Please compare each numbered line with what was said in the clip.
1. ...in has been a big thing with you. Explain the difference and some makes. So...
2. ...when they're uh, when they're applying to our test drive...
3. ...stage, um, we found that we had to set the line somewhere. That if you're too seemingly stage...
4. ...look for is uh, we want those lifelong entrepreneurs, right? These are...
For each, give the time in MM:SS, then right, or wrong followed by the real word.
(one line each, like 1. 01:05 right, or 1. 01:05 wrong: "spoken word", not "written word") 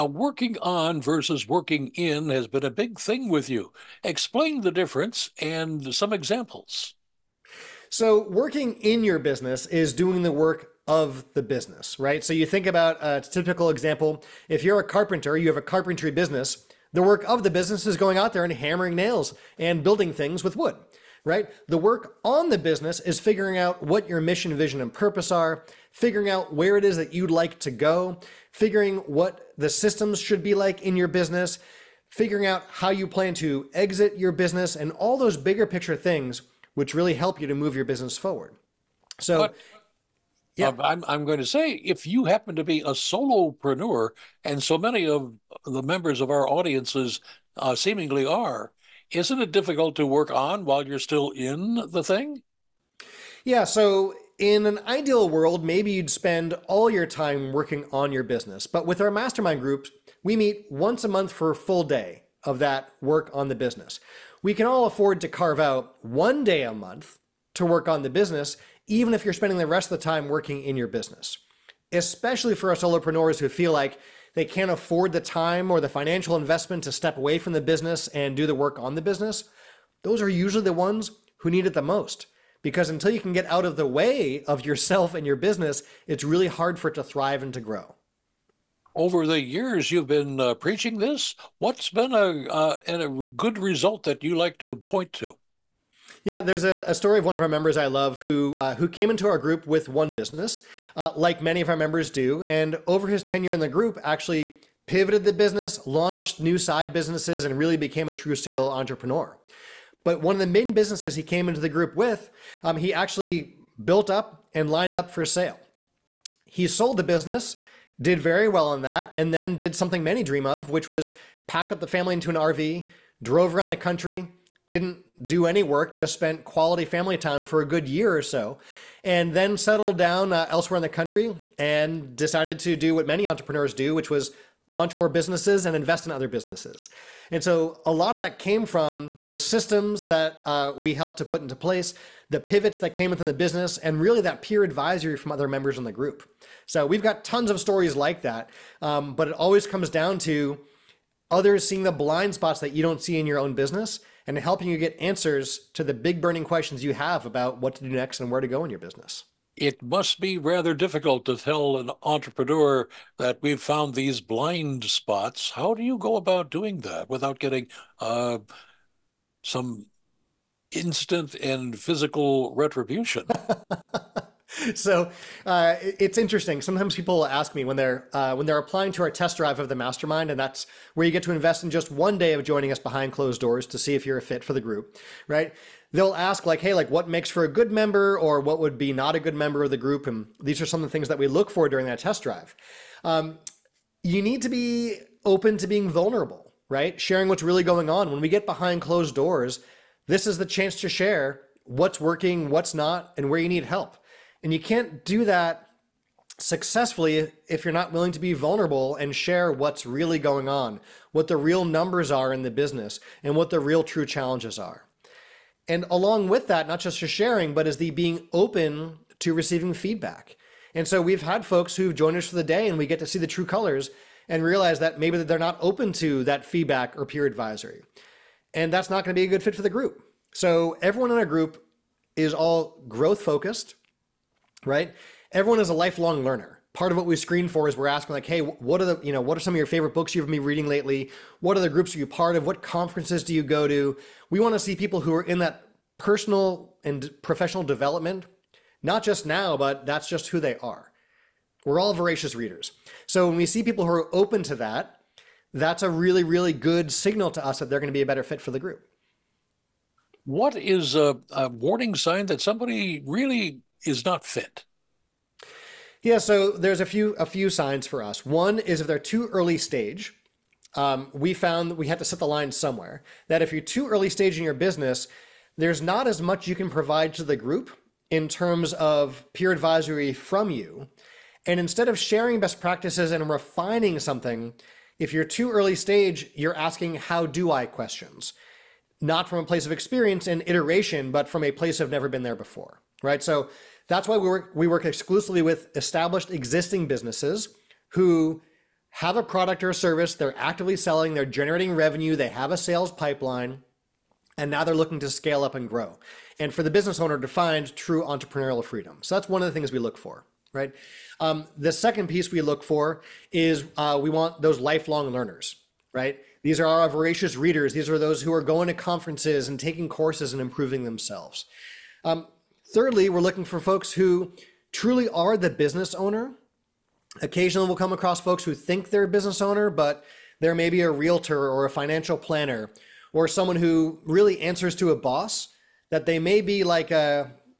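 1. 00:01 wrong: "examples", not "makes"
2. 02:57 right
3. 04:29 wrong: "early", not "seemingly"
4. 05:12 wrong: "learners", not "entrepreneurs".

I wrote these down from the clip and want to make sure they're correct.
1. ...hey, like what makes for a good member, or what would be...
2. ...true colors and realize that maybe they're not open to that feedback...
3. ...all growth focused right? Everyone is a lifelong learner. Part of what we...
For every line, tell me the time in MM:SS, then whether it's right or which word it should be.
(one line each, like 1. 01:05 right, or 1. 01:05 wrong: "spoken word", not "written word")
1. 03:06 right
2. 03:43 right
3. 03:52 right.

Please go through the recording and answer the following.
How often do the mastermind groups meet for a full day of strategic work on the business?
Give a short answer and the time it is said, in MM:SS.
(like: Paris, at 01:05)
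once a month, at 01:00.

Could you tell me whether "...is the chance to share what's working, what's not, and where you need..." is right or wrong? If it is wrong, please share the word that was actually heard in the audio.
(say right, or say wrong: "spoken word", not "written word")
right.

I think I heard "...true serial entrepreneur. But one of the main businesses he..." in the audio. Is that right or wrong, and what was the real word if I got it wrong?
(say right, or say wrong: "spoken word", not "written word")
right.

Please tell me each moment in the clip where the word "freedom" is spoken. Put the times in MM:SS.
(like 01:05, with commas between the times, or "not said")
05:08.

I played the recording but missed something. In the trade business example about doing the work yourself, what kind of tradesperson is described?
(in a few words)
carpenter.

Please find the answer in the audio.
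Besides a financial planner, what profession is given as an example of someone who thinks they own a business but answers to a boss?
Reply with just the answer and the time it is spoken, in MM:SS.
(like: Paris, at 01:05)
realtor, at 05:30.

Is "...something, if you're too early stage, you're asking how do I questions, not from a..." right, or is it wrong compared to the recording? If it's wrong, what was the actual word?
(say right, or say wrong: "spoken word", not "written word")
right.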